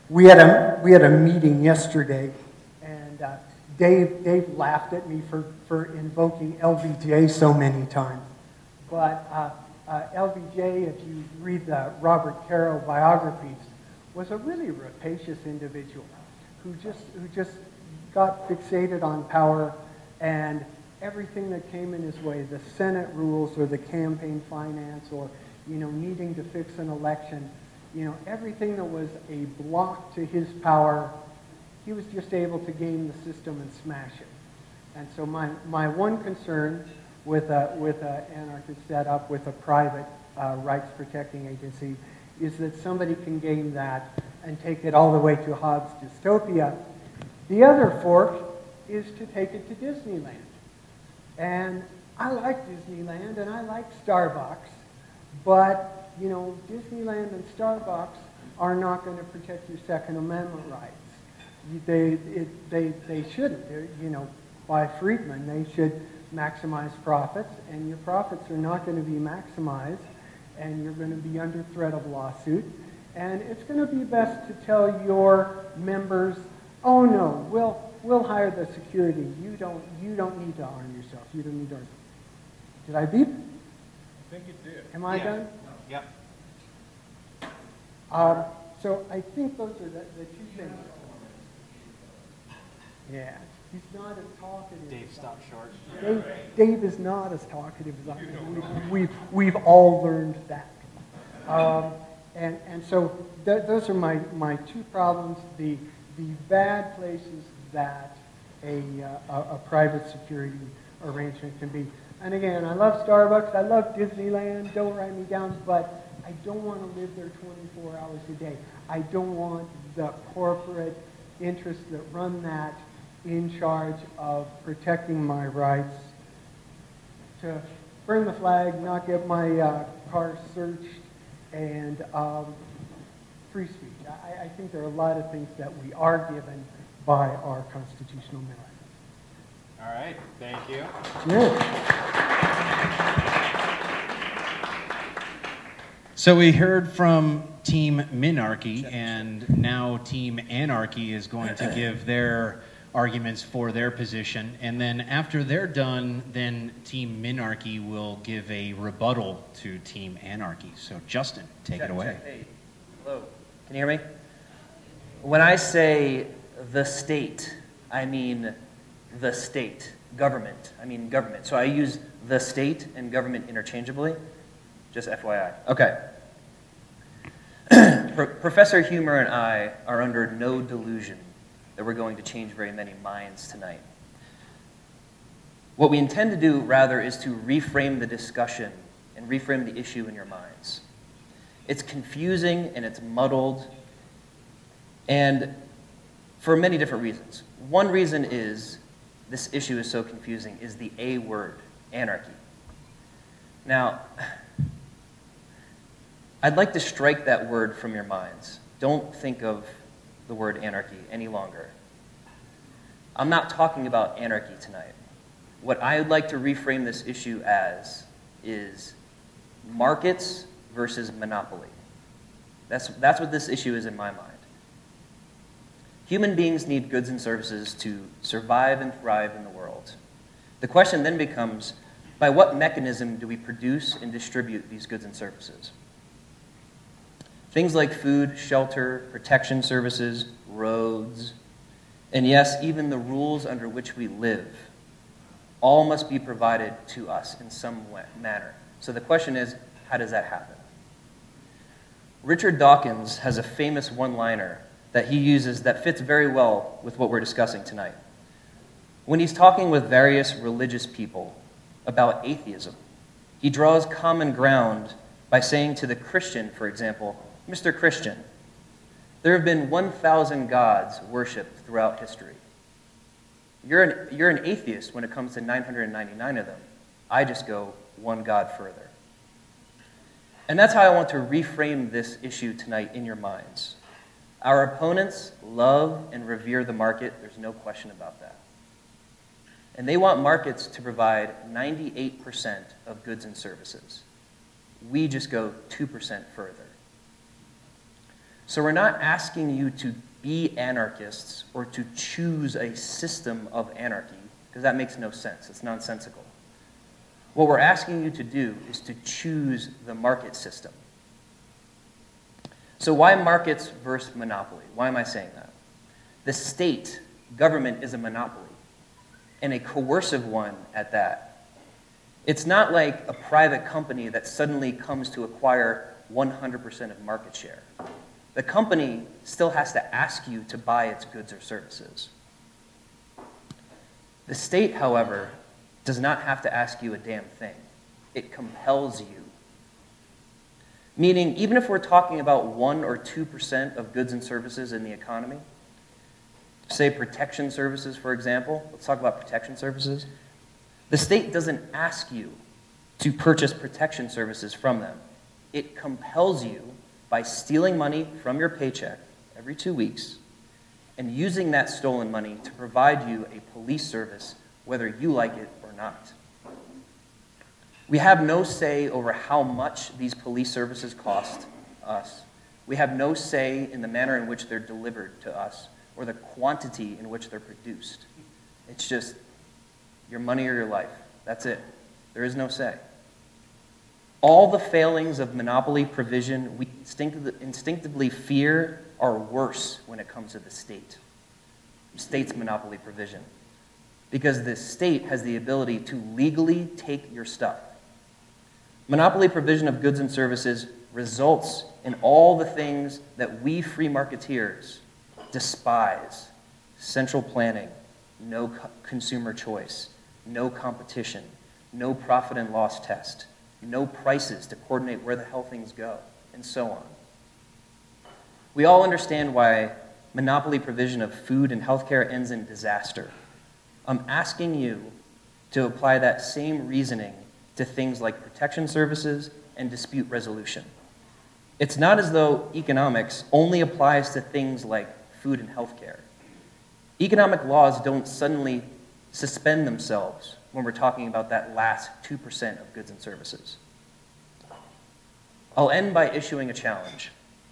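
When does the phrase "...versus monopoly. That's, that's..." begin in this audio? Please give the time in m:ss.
3:40.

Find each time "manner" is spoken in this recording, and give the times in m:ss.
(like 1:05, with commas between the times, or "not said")
4:08, 6:13.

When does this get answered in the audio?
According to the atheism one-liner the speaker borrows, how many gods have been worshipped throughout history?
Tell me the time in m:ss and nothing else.
4:29.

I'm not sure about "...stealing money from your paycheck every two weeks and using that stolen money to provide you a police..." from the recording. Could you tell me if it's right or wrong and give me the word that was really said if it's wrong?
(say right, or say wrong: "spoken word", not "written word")
right.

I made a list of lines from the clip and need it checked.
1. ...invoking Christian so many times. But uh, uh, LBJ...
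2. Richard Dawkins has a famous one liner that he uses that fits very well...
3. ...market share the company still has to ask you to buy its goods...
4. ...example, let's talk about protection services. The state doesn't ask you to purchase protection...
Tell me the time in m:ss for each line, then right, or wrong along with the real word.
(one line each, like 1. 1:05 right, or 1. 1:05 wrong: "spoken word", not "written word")
1. 0:05 wrong: "LBJ", not "Christian"
2. 4:12 right
3. 5:27 right
4. 5:48 right.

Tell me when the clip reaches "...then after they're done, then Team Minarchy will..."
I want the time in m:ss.
2:34.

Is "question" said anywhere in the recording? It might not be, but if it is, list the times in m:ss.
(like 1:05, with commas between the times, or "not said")
3:50, 4:09, 4:47.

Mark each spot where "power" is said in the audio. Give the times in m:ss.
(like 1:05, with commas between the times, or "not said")
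0:19, 0:30.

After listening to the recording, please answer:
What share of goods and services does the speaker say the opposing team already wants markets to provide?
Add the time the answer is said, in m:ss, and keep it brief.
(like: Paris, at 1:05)
98%, at 4:51.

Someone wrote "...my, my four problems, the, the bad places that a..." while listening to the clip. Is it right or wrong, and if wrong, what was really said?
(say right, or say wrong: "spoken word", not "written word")
wrong: "two", not "four".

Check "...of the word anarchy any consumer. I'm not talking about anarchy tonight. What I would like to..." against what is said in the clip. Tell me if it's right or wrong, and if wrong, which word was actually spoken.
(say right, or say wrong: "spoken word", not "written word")
wrong: "longer", not "consumer".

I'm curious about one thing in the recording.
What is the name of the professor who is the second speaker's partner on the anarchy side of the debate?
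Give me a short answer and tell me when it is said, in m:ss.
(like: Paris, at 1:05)
Professor Humer, at 2:58.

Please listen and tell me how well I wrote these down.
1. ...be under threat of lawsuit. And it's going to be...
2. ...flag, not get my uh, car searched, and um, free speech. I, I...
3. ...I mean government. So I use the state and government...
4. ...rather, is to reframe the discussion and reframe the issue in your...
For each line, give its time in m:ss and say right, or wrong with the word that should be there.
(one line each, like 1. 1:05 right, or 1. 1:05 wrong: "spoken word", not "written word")
1. 1:11 right
2. 2:08 right
3. 2:50 right
4. 3:06 right.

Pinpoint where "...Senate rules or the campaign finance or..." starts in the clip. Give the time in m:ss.
0:22.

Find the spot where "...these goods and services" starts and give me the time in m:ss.
3:54.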